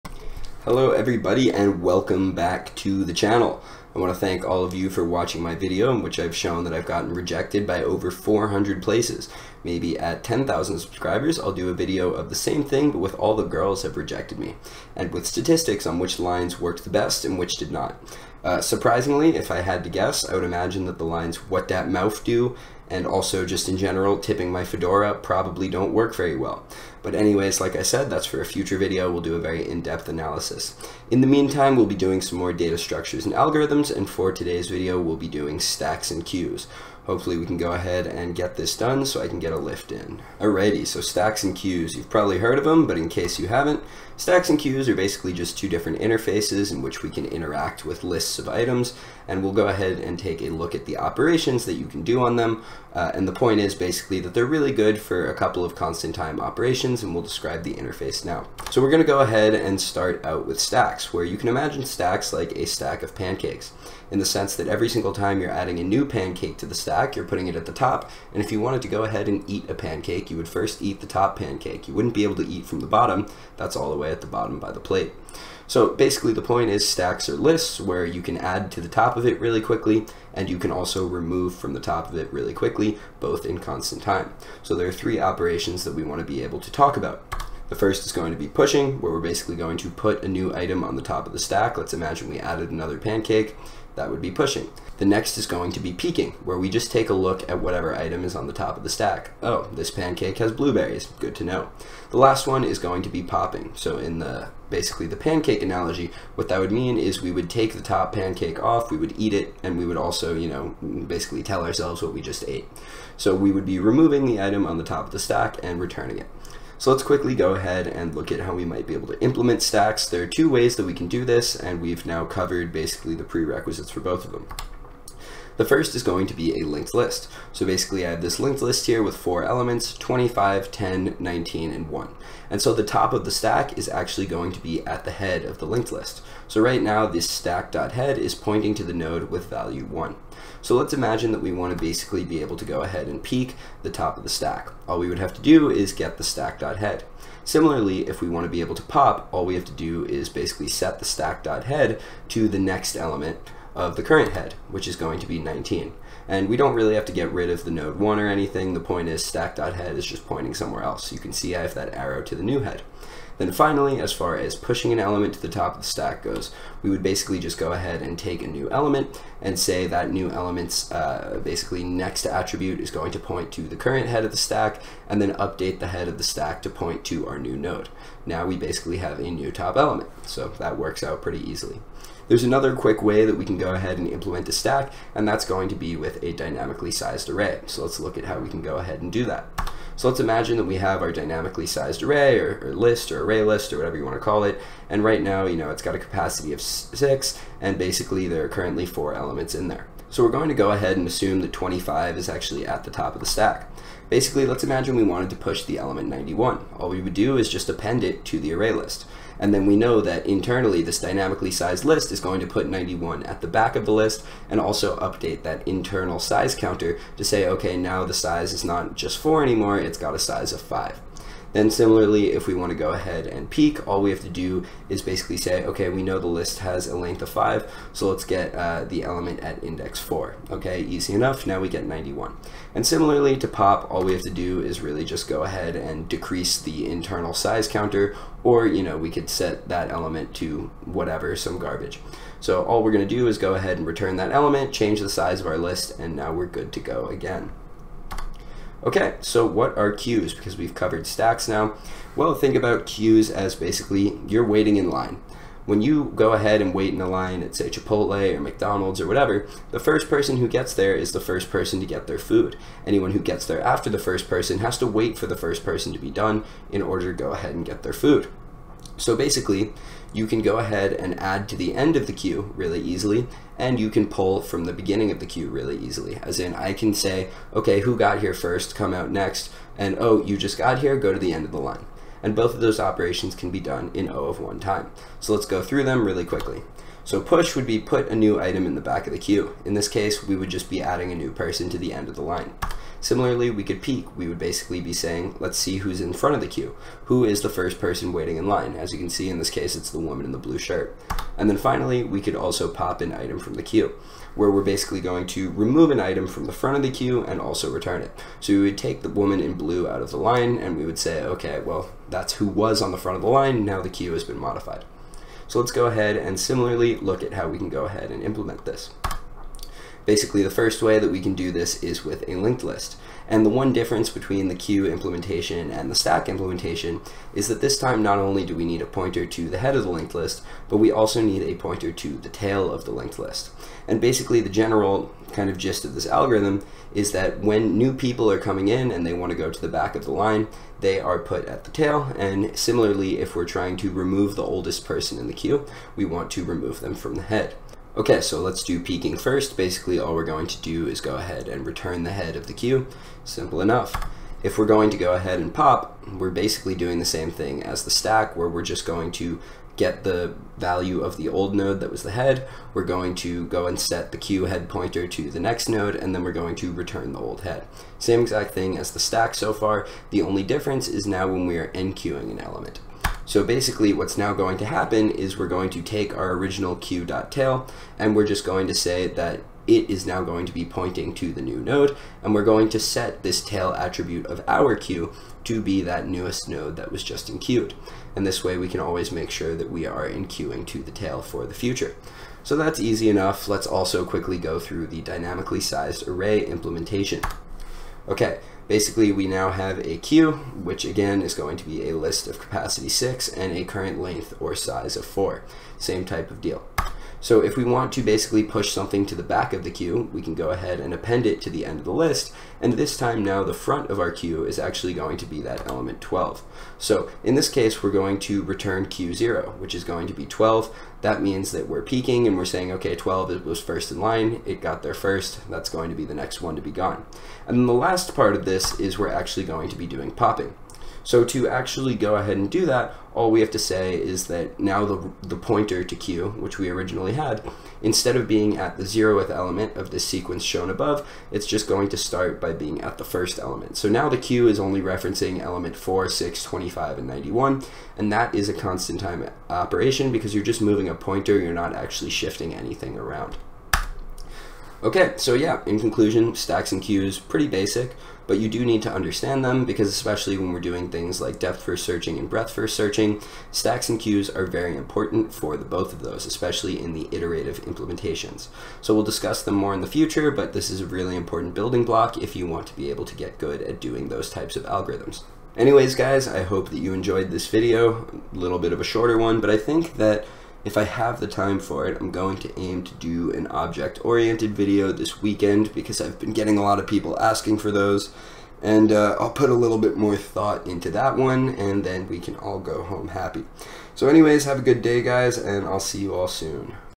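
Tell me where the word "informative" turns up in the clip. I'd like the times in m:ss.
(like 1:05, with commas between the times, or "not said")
not said.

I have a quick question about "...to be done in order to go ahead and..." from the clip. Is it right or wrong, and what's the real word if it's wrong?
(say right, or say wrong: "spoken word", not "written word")
right.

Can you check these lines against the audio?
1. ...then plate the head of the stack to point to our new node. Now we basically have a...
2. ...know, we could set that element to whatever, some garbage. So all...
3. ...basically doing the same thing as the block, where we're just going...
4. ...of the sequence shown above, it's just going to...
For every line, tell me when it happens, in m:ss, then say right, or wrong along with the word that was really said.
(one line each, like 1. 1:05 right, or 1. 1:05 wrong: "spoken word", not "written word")
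1. 2:55 wrong: "update", not "plate"
2. 3:58 right
3. 5:56 wrong: "stack", not "block"
4. 7:19 right.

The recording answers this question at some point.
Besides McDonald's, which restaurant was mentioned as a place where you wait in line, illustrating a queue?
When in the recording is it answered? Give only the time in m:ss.
4:17.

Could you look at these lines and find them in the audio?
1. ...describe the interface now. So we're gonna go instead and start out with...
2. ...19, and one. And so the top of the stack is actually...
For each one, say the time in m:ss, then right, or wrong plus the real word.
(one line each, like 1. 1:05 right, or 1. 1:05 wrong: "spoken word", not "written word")
1. 0:57 wrong: "ahead", not "instead"
2. 2:11 right.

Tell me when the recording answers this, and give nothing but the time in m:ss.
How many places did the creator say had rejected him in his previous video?
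0:07.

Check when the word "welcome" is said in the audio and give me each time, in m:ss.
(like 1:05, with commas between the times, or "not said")
0:01.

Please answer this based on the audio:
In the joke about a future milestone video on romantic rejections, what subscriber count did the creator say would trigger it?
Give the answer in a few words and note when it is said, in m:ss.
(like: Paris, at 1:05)
10,000, at 0:10.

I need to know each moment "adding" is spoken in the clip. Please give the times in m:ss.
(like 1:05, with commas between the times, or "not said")
1:05, 4:50.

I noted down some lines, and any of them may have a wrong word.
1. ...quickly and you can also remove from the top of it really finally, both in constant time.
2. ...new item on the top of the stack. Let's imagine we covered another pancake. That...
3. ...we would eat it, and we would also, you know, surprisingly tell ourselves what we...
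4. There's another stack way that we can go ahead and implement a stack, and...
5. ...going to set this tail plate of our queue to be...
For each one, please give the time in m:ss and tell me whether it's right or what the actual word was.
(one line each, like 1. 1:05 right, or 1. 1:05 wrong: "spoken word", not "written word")
1. 1:19 wrong: "quickly", not "finally"
2. 1:30 wrong: "added", not "covered"
3. 1:48 wrong: "basically", not "surprisingly"
4. 3:02 wrong: "quick", not "stack"
5. 6:22 wrong: "attribute", not "plate".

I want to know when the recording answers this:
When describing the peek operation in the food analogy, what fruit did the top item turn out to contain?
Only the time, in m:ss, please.
1:40.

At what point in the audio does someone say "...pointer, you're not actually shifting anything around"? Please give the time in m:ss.
7:30.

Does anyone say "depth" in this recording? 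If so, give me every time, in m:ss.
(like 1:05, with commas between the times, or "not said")
0:29, 7:41.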